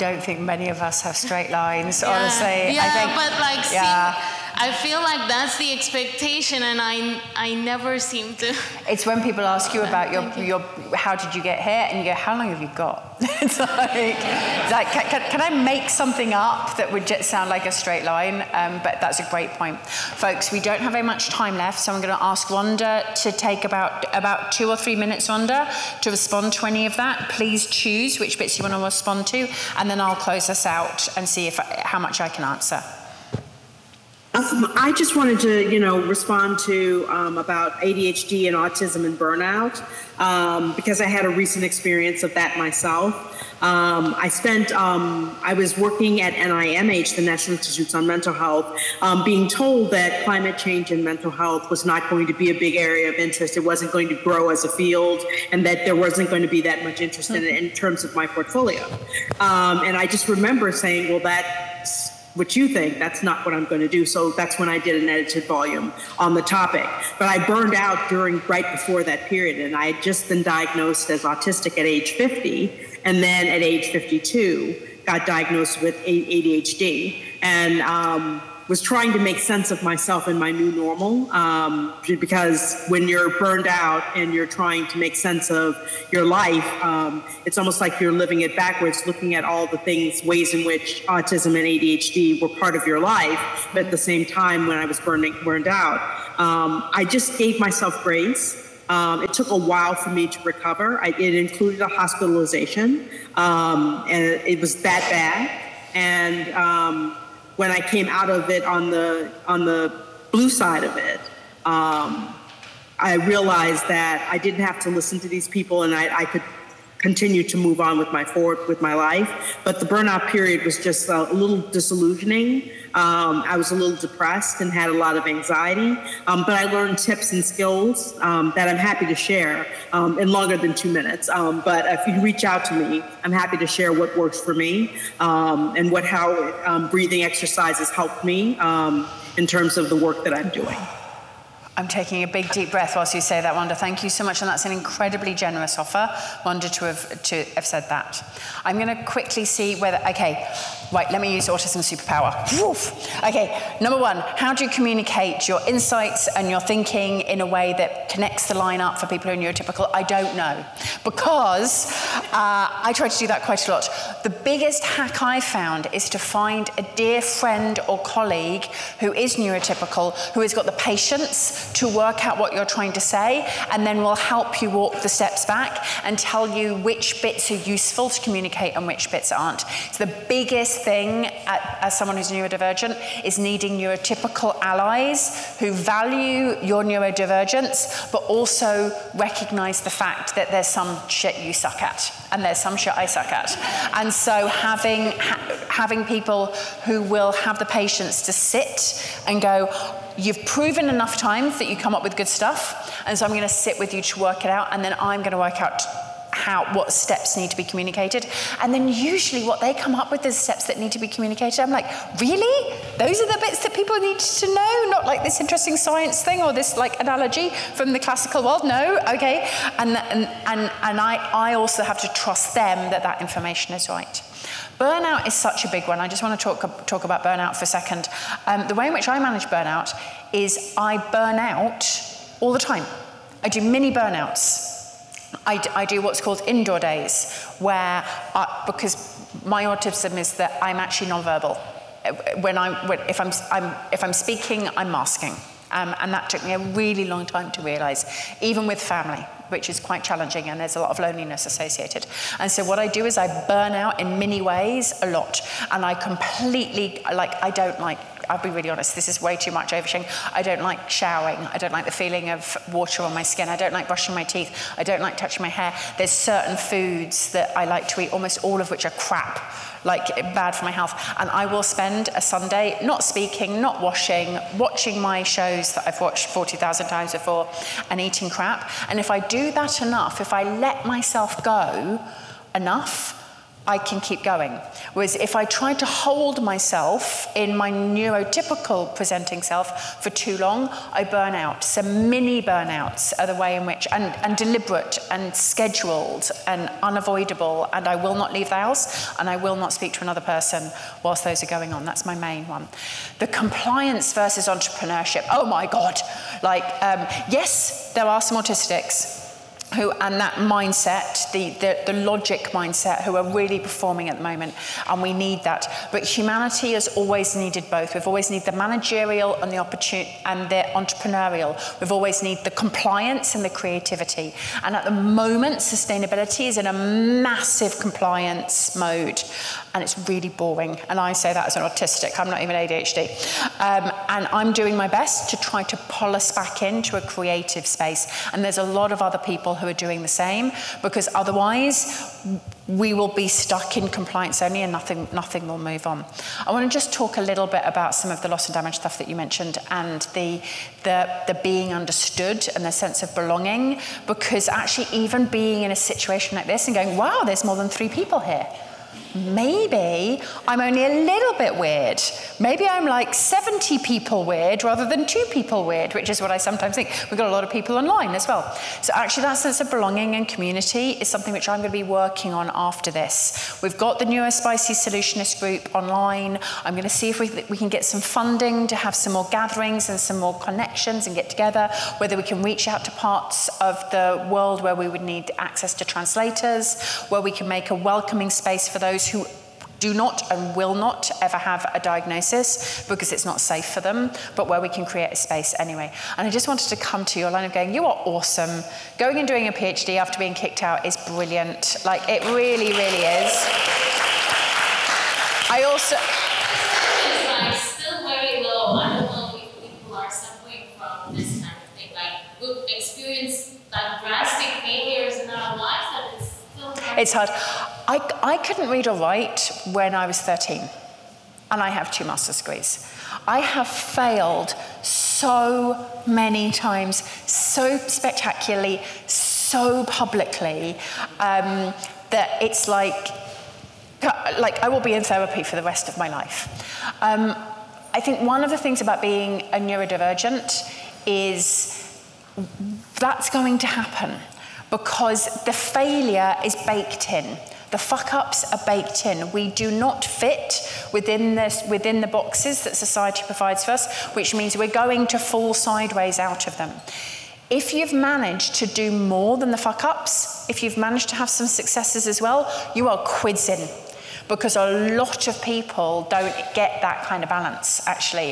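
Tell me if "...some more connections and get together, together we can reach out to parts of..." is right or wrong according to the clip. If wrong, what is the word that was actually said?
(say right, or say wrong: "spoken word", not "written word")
wrong: "whether", not "together".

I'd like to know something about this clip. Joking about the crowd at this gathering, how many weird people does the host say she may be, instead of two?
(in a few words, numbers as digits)
70.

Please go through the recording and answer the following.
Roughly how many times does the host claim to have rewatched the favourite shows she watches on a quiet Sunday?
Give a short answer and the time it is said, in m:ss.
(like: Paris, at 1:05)
40,000, at 4:36.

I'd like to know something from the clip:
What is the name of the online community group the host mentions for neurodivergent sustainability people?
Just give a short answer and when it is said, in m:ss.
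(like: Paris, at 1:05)
Neurospicy Solutionist group, at 6:14.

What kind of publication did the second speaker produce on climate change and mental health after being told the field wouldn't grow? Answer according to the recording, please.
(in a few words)
An edited volume.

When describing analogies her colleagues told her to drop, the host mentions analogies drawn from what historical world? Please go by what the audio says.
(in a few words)
The classical world.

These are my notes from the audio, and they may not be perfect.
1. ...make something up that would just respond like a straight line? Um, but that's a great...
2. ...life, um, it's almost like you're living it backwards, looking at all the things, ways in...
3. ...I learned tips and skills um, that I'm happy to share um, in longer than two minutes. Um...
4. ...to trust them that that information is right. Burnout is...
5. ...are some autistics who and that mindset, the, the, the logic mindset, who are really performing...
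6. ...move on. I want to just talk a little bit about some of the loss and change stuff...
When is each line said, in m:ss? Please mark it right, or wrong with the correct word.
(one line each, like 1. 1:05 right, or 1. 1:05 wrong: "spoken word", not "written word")
1. 0:15 wrong: "sound", not "respond"
2. 1:26 right
3. 2:06 right
4. 3:42 right
5. 5:08 right
6. 5:45 wrong: "damage", not "change".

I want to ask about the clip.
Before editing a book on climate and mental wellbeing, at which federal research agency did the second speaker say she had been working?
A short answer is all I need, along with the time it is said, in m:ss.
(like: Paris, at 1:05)
NIMH, at 0:46.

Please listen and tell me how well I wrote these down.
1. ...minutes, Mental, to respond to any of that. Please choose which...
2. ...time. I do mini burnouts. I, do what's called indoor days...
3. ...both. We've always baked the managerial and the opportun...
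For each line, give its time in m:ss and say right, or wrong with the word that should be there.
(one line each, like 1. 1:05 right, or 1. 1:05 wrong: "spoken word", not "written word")
1. 0:24 wrong: "Rhonda", not "Mental"
2. 3:52 right
3. 5:17 wrong: "needed", not "baked".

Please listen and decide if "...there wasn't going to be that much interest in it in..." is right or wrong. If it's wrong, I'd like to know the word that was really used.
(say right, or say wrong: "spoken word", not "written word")
right.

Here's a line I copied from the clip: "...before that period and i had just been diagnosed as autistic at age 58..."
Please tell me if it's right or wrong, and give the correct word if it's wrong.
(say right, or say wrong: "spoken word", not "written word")
wrong: "50", not "58".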